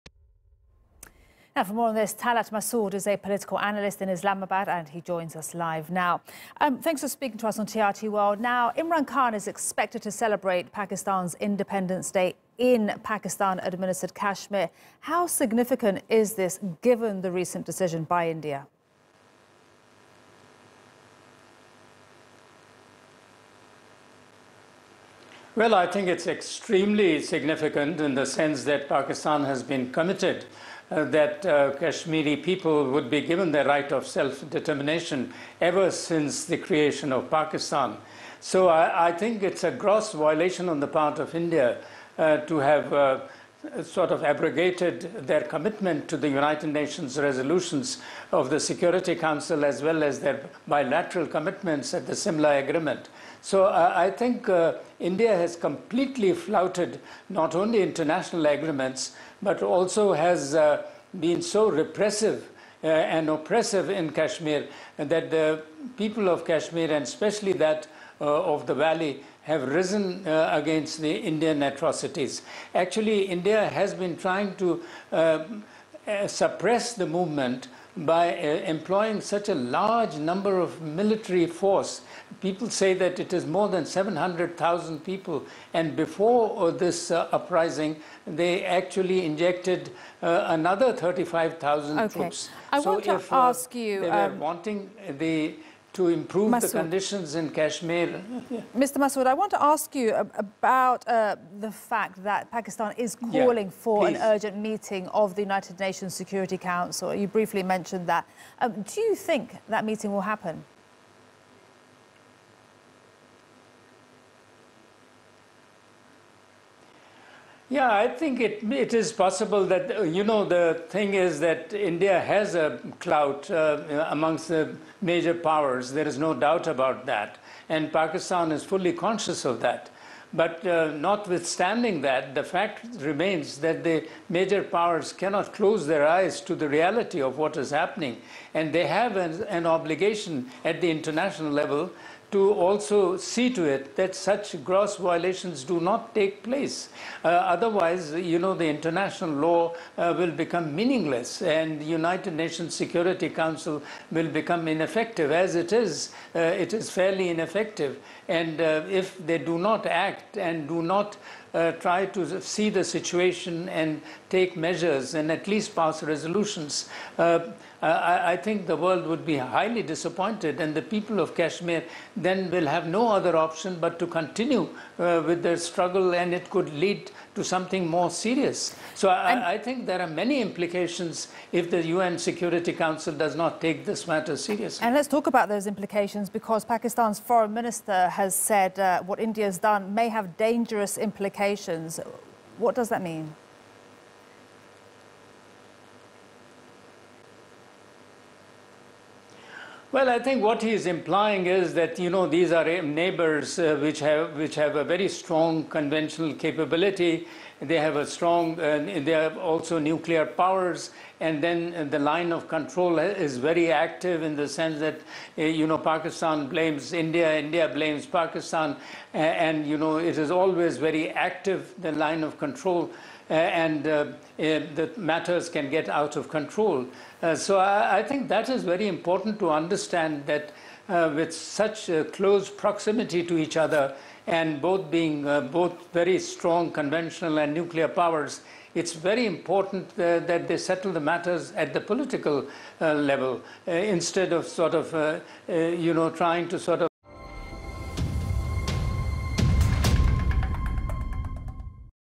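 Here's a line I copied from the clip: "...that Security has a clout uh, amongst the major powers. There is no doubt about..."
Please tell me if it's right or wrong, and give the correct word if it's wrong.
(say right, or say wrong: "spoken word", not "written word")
wrong: "India", not "Security".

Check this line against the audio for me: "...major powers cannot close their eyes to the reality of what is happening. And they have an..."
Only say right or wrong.
right.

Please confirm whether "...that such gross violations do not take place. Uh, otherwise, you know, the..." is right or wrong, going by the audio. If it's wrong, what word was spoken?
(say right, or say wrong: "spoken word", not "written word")
right.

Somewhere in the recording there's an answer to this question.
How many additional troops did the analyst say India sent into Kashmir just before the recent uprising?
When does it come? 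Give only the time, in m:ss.
1:30.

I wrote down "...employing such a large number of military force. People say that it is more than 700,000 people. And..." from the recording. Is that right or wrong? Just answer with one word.
right.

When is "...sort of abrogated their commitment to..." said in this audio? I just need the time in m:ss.
0:43.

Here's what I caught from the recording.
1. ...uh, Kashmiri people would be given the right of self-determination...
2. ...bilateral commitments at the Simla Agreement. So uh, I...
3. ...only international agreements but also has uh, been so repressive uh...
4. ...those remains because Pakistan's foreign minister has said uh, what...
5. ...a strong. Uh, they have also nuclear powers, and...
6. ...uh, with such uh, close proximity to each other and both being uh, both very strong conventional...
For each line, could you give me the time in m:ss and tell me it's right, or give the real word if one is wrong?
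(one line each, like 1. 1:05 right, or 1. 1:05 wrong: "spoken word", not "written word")
1. 0:31 right
2. 0:50 right
3. 0:57 right
4. 3:05 wrong: "implications", not "remains"
5. 3:27 right
6. 3:50 right.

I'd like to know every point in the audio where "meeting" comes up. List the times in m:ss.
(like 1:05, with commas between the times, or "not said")
1:44, 1:49.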